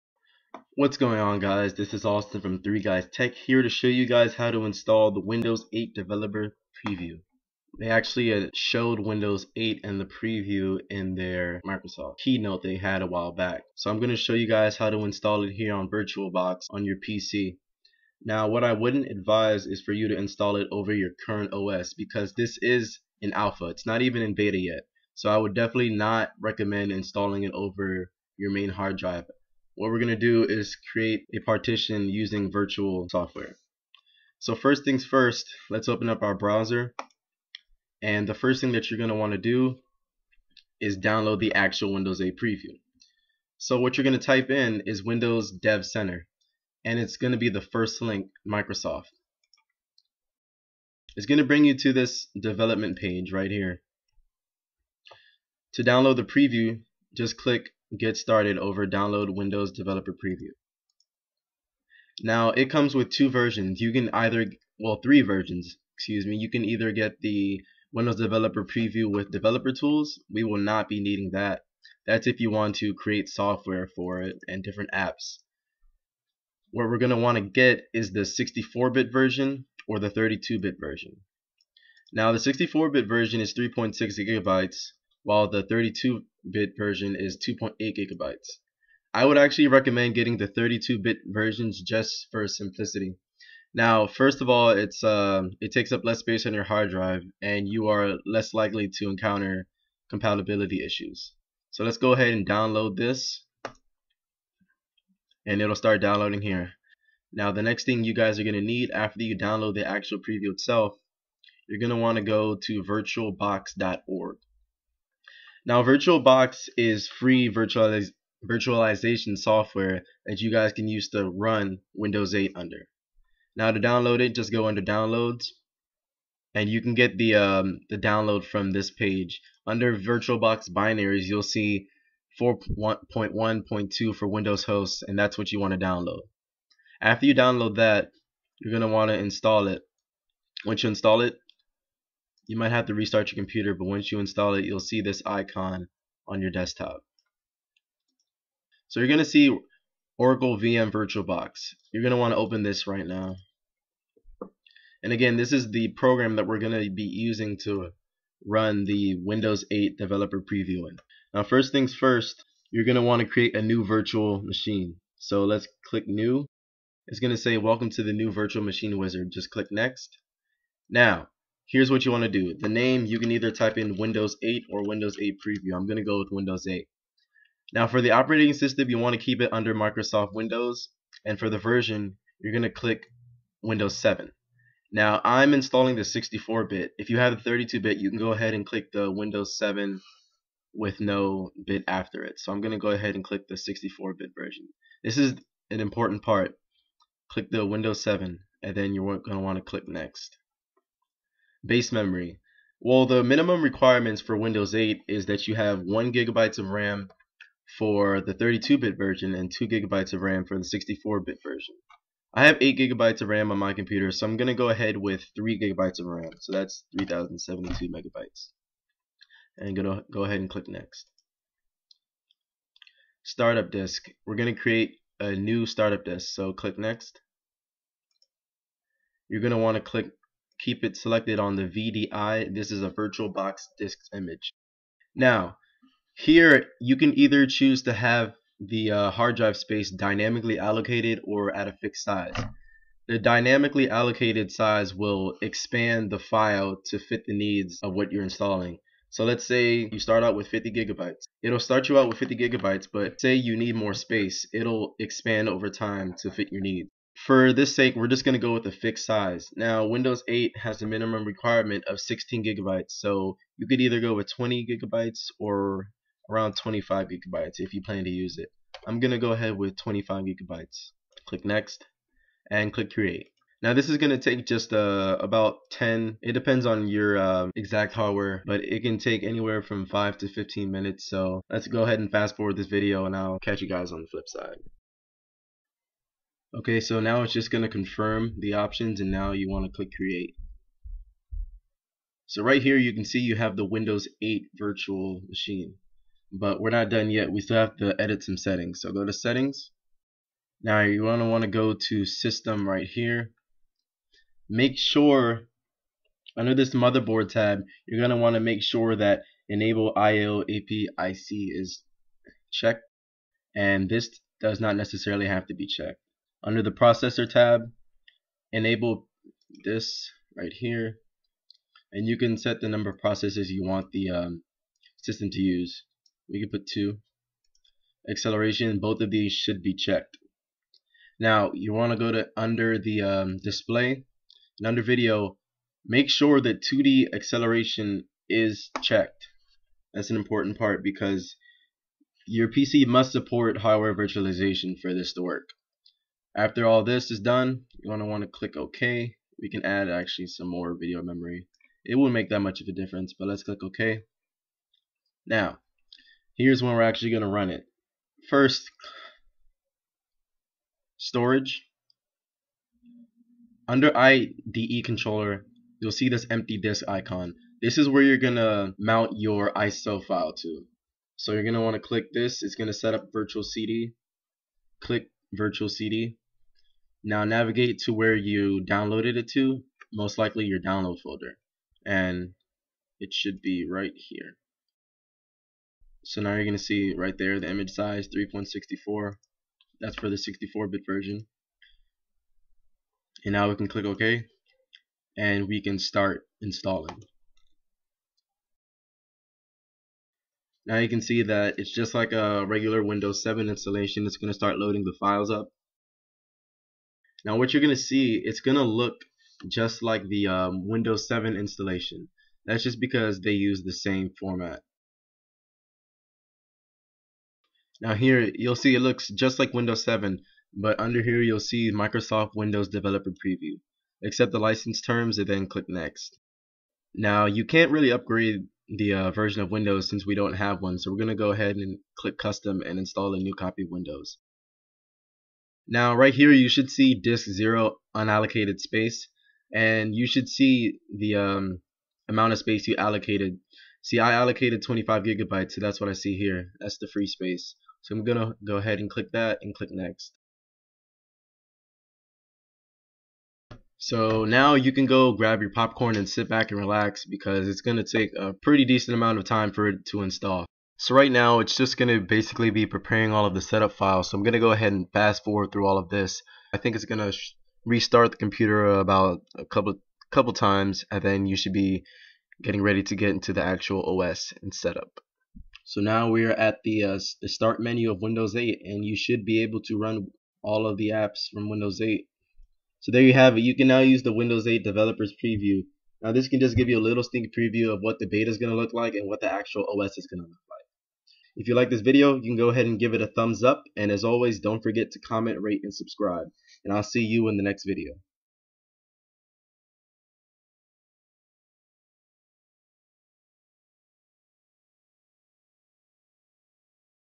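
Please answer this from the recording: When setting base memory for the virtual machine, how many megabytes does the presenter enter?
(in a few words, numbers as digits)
3072.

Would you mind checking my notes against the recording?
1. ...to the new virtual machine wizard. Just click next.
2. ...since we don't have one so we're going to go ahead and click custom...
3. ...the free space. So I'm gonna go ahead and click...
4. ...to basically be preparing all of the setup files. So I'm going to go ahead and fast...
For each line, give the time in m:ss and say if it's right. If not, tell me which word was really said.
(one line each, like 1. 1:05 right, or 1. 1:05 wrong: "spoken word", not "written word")
1. 2:47 right
2. 7:09 right
3. 7:26 right
4. 7:41 right.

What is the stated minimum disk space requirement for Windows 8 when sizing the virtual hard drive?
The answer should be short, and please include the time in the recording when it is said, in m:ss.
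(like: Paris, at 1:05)
16 gigabytes, at 4:21.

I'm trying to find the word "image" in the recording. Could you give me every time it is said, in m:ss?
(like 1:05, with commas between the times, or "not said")
3:54, 6:27.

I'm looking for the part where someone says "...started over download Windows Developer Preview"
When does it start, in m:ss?
0:58.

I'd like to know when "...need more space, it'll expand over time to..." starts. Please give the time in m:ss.
4:13.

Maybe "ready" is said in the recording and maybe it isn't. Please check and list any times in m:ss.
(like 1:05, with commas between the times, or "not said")
7:52.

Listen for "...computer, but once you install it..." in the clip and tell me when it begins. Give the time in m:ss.
2:23.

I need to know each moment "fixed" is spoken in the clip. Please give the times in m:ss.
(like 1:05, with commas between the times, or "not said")
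4:01, 4:18.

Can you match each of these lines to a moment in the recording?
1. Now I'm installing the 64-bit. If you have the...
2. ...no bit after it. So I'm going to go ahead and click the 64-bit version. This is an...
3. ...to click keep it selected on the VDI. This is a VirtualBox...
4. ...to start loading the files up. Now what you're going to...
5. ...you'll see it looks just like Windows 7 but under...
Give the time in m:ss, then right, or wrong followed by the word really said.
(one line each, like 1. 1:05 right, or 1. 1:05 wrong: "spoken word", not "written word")
1. 3:04 right
2. 3:10 right
3. 3:49 right
4. 6:44 right
5. 6:58 right.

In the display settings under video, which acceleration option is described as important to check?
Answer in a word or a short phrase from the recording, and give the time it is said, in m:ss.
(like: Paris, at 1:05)
2D acceleration, at 5:36.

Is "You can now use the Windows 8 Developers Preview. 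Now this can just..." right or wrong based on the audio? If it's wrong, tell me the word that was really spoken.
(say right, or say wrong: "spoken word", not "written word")
right.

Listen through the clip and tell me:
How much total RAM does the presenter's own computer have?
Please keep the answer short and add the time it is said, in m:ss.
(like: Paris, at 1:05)
8 gigabytes, at 3:32.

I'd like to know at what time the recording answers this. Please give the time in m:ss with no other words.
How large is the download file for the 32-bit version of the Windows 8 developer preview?
1:27.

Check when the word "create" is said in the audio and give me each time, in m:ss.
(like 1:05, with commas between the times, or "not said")
0:30, 1:12, 2:43, 3:44, 4:32, 4:49.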